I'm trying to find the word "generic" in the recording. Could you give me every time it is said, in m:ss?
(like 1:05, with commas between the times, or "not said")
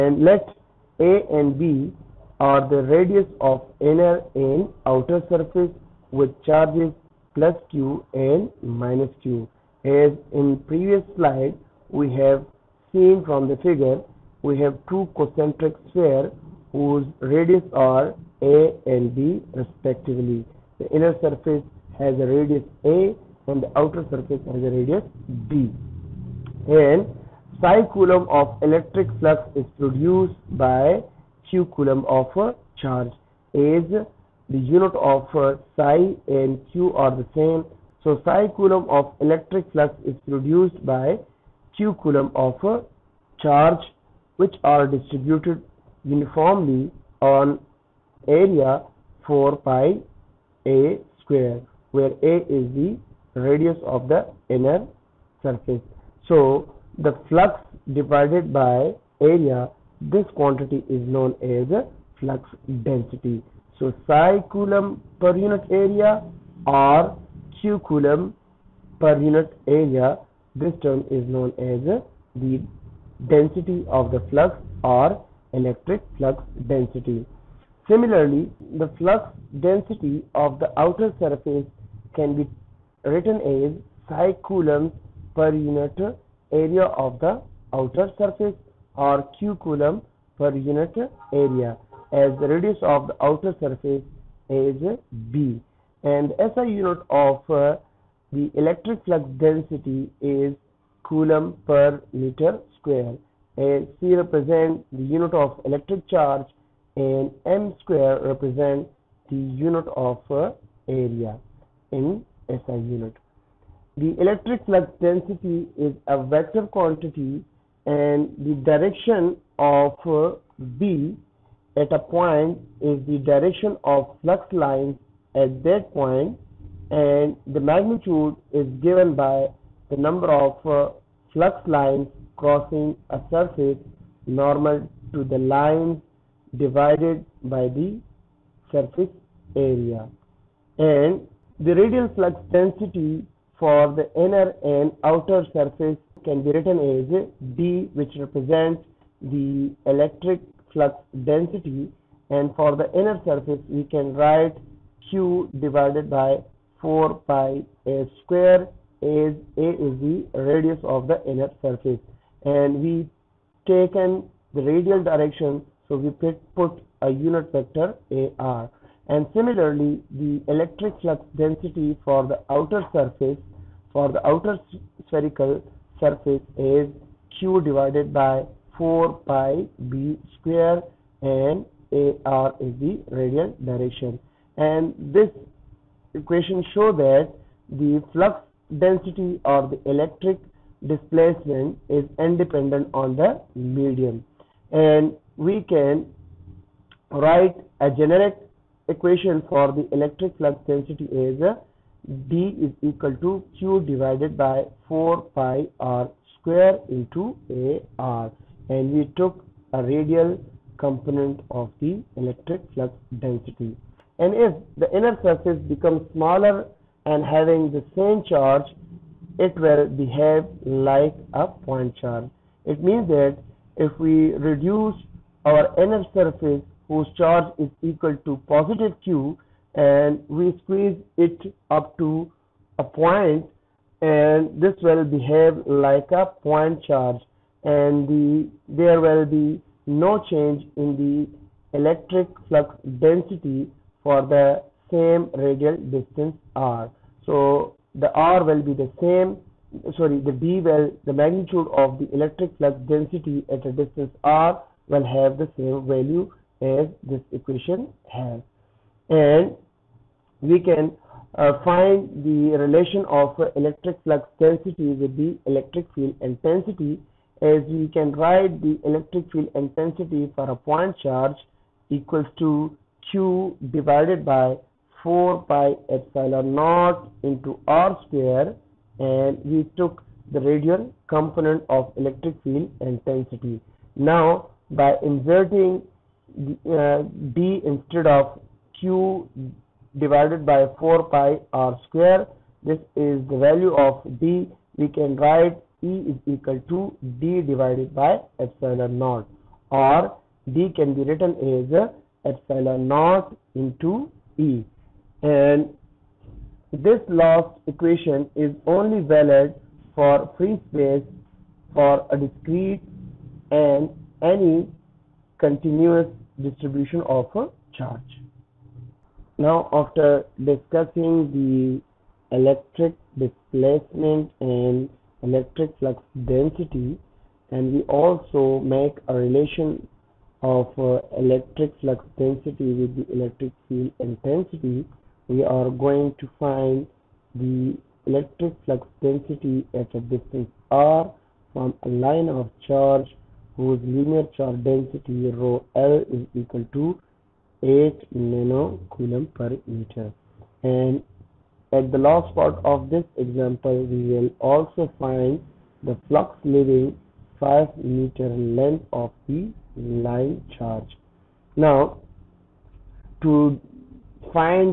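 3:17.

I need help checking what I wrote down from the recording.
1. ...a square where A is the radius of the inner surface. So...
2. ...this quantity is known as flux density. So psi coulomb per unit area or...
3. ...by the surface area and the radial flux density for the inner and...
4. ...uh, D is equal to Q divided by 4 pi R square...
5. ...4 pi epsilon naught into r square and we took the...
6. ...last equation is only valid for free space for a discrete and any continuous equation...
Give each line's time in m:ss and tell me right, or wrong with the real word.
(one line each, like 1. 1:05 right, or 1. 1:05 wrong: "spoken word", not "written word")
1. 0:50 right
2. 1:00 right
3. 2:17 right
4. 3:21 right
5. 4:35 right
6. 5:07 wrong: "distribution", not "equation".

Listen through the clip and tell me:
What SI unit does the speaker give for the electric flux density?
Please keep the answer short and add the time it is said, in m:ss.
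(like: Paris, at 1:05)
coulomb per meter square, at 1:41.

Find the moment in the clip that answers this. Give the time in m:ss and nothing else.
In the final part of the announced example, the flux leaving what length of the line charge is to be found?
5:57.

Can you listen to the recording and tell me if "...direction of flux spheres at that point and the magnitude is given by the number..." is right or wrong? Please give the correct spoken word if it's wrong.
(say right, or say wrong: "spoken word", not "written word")
wrong: "lines", not "spheres".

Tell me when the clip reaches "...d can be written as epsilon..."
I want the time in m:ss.
5:00.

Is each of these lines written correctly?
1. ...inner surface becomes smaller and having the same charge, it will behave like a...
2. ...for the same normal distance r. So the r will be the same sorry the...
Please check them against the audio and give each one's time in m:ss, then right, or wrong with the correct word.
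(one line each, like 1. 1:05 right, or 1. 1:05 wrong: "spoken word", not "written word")
1. 3:34 right
2. 4:04 wrong: "radial", not "normal".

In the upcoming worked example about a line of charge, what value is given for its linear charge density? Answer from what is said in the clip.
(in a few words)
8 coulomb per meter.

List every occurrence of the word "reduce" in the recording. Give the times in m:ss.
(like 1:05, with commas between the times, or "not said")
3:44.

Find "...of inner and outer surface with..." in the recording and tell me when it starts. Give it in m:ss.
0:03.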